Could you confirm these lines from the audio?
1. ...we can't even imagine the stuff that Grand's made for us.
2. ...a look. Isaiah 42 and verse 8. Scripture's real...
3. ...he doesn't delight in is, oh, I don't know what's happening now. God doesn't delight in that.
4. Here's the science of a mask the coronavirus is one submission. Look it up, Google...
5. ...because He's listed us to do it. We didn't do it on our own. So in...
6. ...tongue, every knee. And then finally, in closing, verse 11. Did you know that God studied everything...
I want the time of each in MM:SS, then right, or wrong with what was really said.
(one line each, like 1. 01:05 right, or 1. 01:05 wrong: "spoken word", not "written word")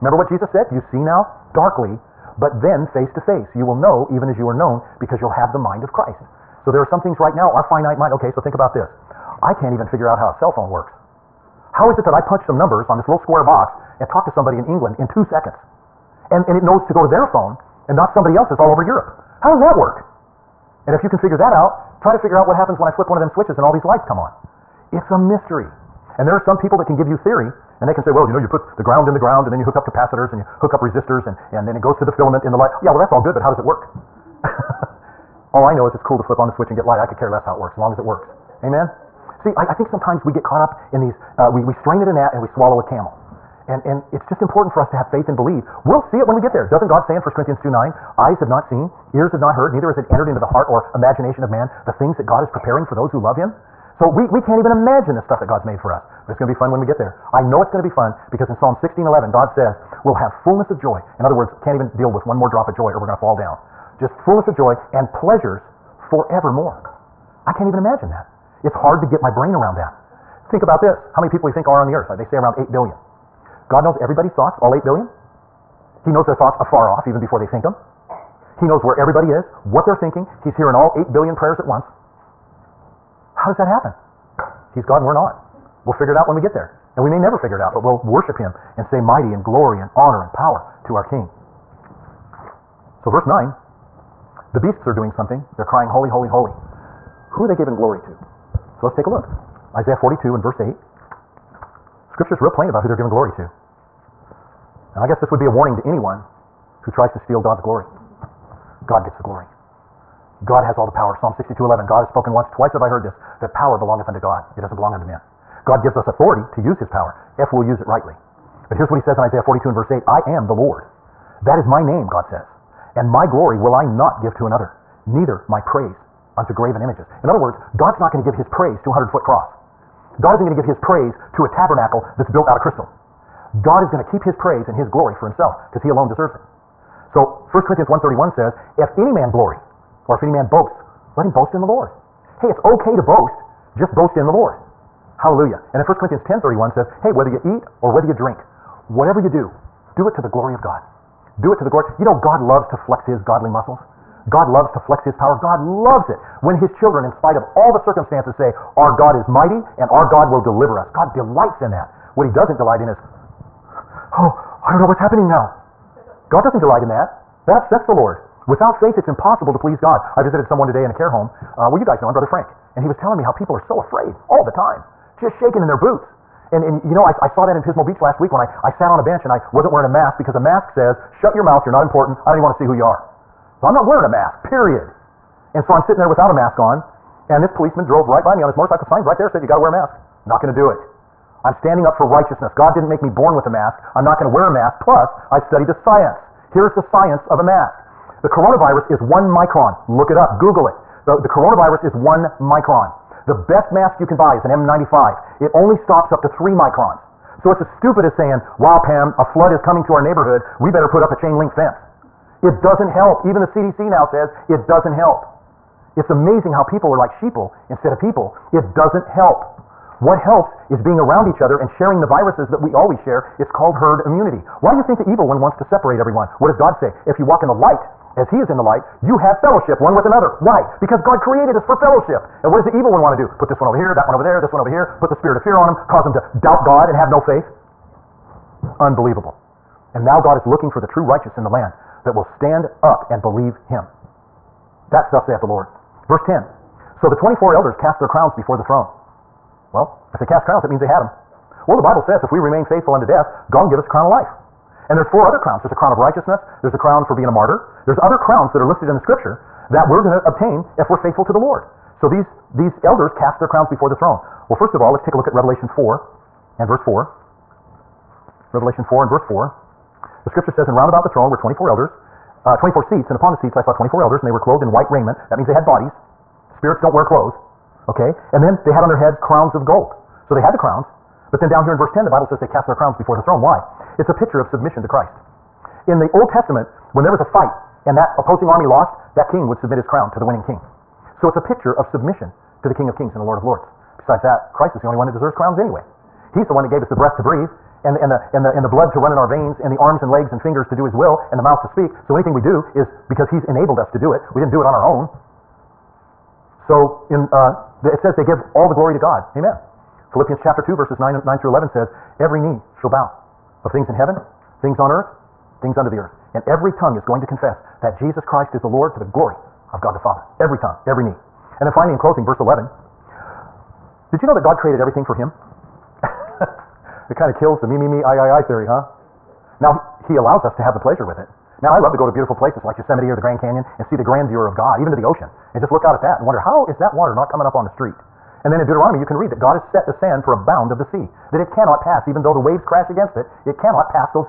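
1. 00:54 wrong: "God", not "Grand"
2. 01:39 right
3. 02:42 right
4. 03:16 wrong: "micron", not "submission"
5. 05:03 wrong: "enabled", not "listed"
6. 05:20 wrong: "created", not "studied".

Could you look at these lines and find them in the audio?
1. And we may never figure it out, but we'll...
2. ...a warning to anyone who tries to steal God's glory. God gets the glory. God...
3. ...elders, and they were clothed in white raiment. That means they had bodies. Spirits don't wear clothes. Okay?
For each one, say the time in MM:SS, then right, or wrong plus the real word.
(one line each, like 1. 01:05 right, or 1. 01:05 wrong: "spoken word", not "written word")
1. 01:26 right
2. 01:45 right
3. 04:34 right.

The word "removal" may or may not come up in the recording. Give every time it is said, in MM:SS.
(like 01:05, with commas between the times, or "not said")
not said.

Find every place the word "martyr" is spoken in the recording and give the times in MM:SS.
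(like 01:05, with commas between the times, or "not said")
04:17.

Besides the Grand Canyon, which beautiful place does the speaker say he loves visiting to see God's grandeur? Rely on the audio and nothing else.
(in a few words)
Yosemite.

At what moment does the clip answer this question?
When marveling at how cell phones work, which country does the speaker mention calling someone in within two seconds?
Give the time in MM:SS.
00:14.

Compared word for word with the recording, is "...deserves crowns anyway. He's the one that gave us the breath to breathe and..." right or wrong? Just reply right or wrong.
right.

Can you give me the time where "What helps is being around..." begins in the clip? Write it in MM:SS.
03:40.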